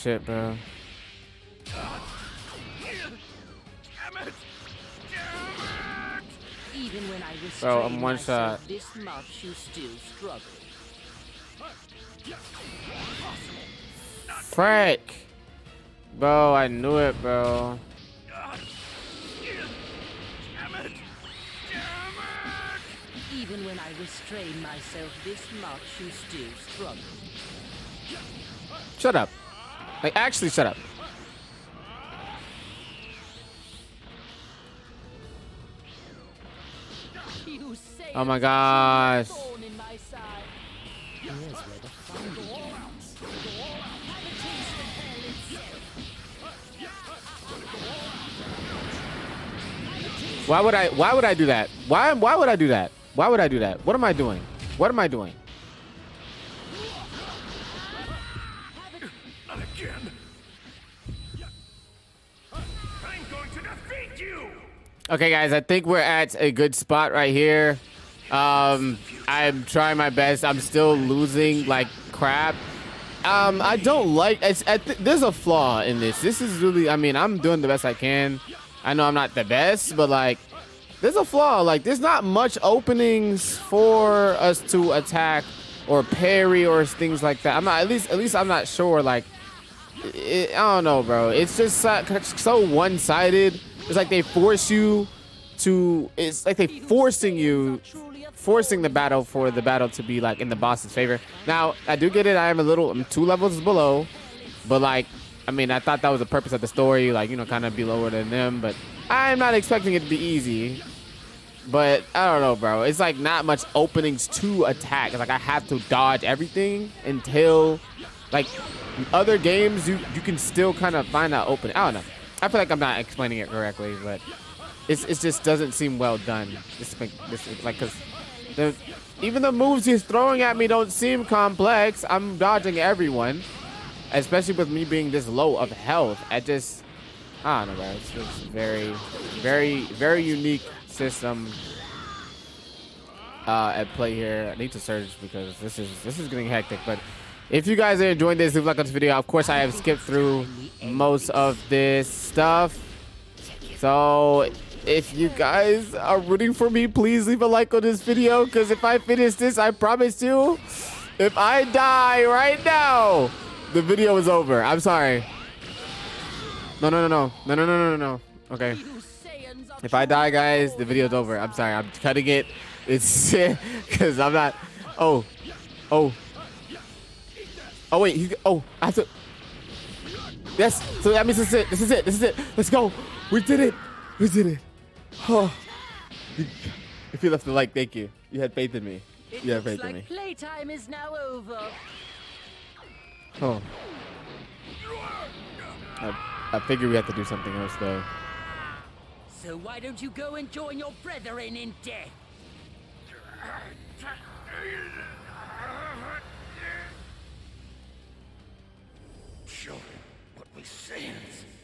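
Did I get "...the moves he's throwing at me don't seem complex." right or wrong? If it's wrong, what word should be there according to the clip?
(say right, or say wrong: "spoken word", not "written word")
right.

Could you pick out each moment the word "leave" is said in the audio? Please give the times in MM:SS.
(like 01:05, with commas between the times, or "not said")
02:28, 02:37.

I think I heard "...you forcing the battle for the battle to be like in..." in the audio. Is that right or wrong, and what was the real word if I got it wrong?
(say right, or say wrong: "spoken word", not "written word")
right.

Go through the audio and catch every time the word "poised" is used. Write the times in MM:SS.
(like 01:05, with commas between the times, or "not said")
not said.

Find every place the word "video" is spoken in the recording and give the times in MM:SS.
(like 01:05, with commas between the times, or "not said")
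02:28, 02:38, 02:43, 02:50.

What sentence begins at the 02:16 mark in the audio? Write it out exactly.
I just, I don't know, bro.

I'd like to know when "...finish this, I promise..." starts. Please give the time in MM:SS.
02:38.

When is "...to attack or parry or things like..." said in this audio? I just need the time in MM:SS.
01:24.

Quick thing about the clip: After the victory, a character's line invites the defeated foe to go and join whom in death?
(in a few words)
your brethren.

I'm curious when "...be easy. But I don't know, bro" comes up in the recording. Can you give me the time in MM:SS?
01:50.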